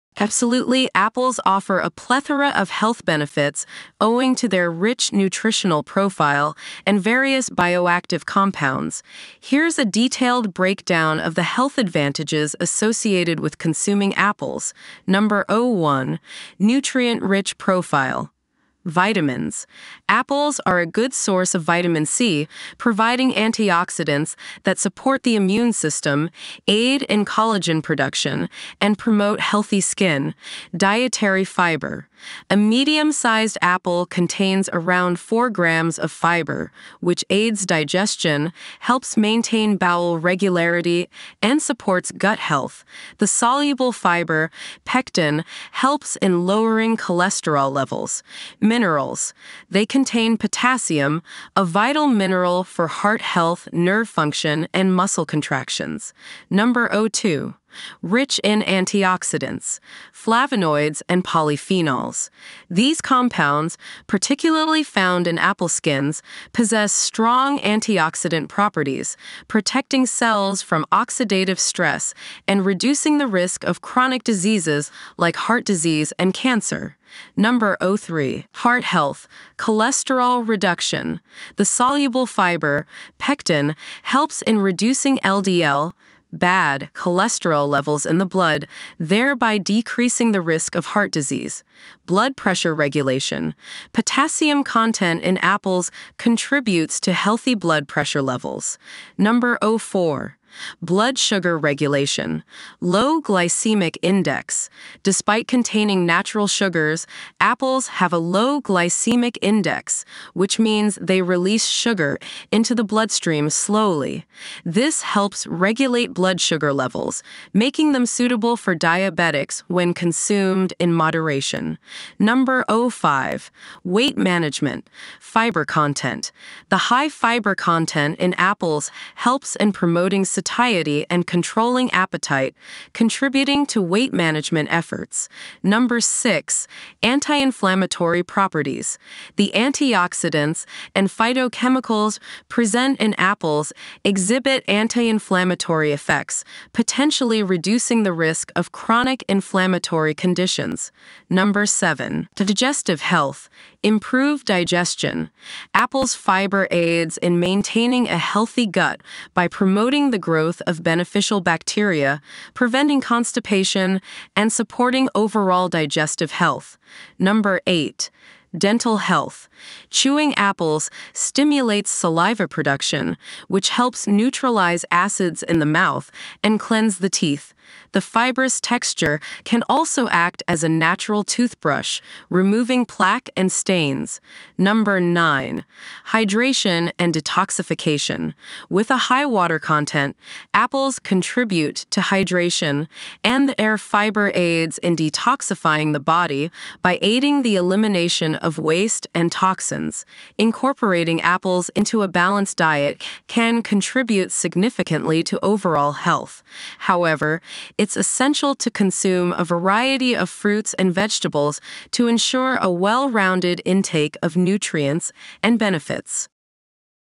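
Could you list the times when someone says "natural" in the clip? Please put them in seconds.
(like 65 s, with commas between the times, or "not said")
106 s, 180 s.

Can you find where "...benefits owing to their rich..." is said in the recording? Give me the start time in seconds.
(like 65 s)
3 s.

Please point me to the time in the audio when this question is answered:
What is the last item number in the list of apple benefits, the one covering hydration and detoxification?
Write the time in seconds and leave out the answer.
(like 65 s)
184 s.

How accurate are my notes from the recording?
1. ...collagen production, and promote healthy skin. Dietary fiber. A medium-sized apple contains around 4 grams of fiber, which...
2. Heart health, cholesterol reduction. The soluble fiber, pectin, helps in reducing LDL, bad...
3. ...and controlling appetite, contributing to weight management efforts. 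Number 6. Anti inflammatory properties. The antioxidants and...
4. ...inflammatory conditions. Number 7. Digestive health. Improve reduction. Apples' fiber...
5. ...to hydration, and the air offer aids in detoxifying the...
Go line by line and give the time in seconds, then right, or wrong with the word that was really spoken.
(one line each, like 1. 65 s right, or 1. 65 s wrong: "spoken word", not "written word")
1. 27 s right
2. 78 s right
3. 131 s right
4. 149 s wrong: "digestion", not "reduction"
5. 191 s wrong: "fiber", not "offer".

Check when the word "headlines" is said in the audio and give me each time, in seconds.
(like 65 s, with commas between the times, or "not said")
not said.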